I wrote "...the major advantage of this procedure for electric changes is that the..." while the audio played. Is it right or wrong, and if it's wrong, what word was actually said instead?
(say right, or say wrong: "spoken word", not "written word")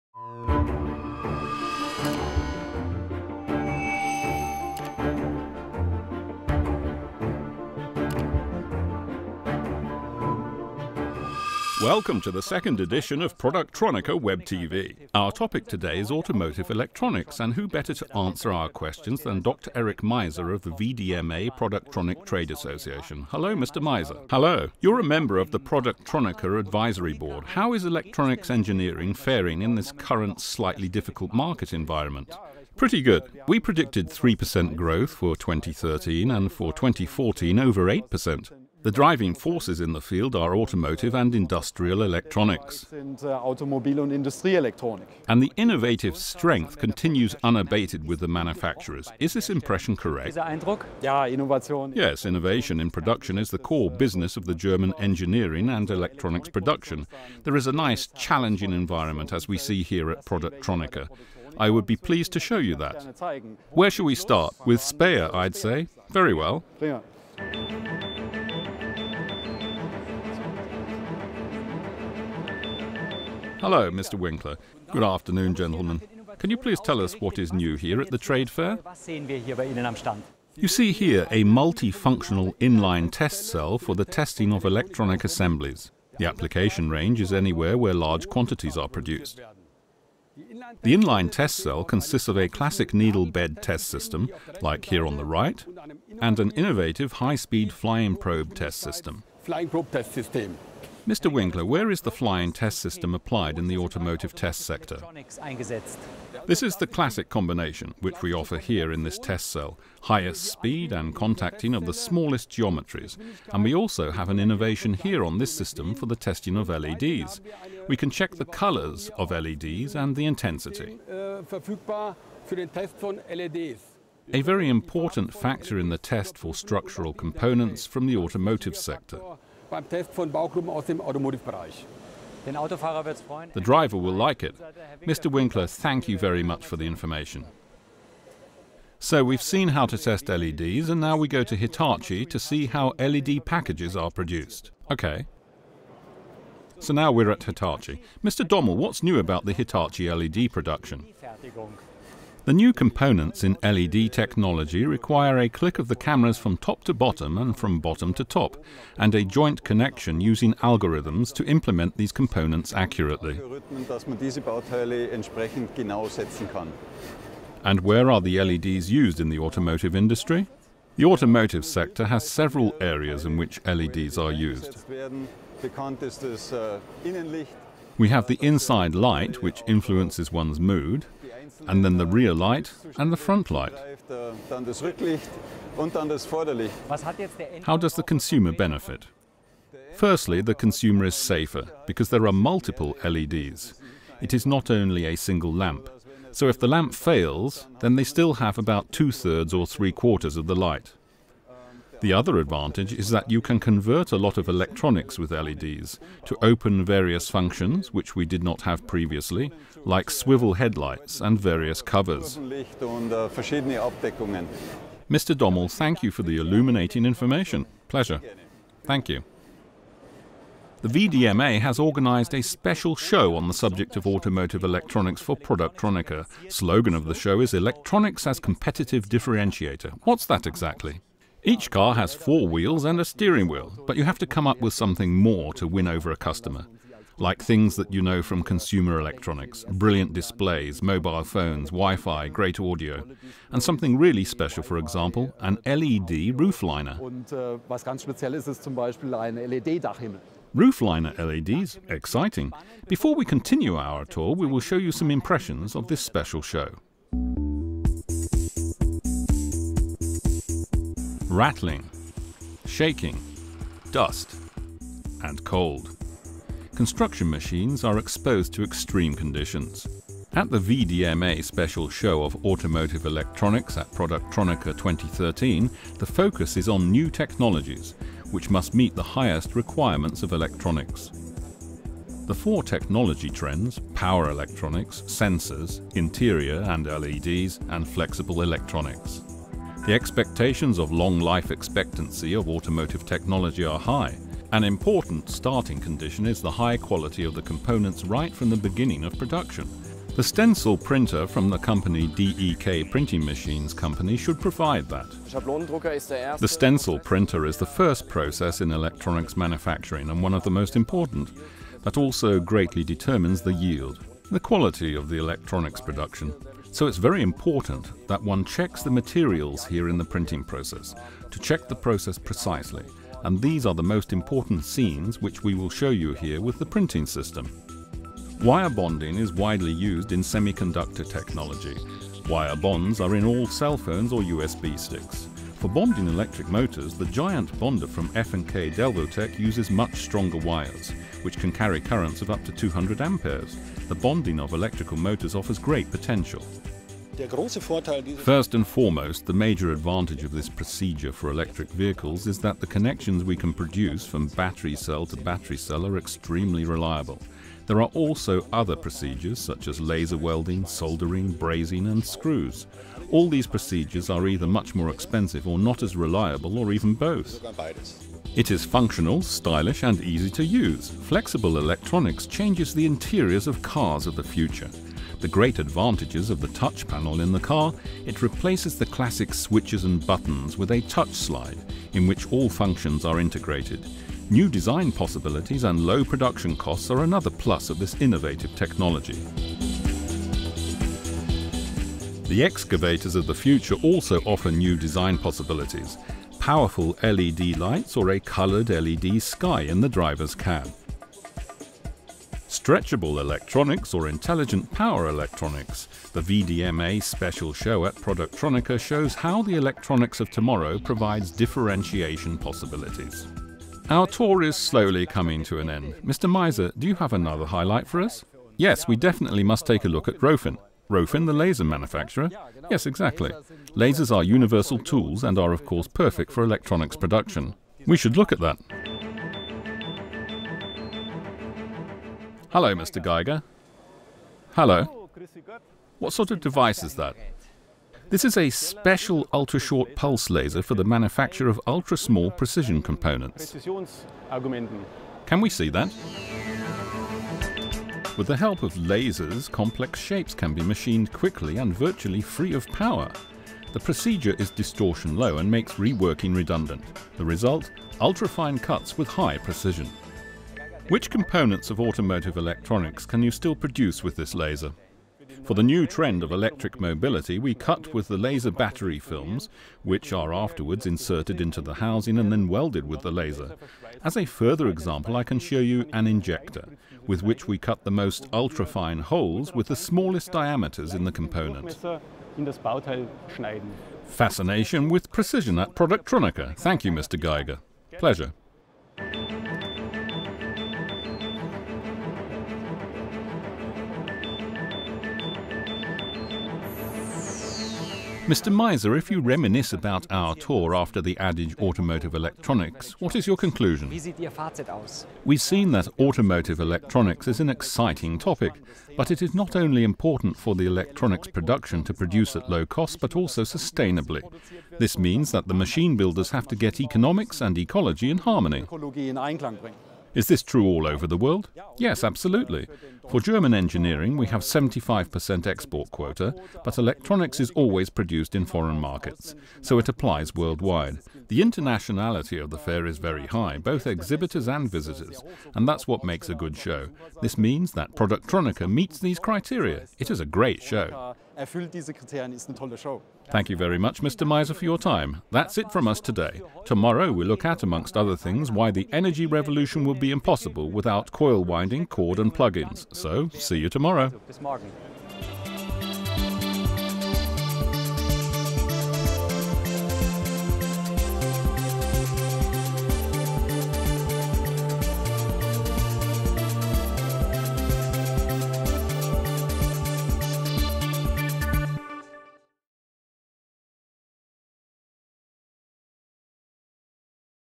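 wrong: "vehicles", not "changes".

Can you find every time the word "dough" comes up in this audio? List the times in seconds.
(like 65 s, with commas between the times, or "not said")
not said.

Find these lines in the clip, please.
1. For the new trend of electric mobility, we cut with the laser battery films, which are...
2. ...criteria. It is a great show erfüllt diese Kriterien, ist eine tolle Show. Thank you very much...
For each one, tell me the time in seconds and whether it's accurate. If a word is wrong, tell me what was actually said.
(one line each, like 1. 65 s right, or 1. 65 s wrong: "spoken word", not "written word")
1. 465 s right
2. 539 s right.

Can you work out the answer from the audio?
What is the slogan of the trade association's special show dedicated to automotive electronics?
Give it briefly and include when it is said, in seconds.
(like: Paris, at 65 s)
Electronics as Competitive Differentiator, at 227 s.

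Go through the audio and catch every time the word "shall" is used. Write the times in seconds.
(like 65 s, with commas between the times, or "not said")
63 s.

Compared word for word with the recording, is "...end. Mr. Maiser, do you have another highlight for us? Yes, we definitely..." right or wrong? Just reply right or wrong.
right.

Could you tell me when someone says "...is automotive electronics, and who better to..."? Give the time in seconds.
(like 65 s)
15 s.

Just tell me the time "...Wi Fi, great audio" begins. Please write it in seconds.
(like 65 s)
241 s.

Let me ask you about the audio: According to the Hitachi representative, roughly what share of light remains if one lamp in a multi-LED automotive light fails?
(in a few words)
two-thirds or three-quarters.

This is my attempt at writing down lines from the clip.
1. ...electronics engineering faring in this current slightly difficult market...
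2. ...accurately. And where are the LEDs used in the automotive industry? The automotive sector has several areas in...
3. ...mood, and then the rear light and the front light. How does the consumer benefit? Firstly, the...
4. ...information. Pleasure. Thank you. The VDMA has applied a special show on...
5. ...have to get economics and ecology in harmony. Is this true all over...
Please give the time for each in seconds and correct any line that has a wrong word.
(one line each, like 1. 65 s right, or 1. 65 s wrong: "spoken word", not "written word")
1. 27 s right
2. 162 s right
3. 180 s right
4. 217 s wrong: "organized", not "applied"
5. 516 s right.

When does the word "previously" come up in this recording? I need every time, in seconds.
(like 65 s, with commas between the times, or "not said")
208 s.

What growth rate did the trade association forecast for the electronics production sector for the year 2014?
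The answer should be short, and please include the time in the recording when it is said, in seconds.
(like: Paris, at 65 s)
over 8%, at 37 s.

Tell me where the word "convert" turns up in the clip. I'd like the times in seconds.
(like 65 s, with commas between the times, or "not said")
203 s.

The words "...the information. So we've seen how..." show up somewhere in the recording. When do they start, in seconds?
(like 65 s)
136 s.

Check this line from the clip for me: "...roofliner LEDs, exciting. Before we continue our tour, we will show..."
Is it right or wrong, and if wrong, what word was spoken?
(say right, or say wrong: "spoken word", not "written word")
right.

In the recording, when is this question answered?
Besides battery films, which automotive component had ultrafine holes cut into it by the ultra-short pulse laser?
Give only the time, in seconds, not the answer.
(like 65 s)
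476 s.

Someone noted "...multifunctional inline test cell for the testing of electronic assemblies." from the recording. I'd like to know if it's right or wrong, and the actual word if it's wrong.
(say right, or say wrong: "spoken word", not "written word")
right.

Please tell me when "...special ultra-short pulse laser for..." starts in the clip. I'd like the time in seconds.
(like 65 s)
438 s.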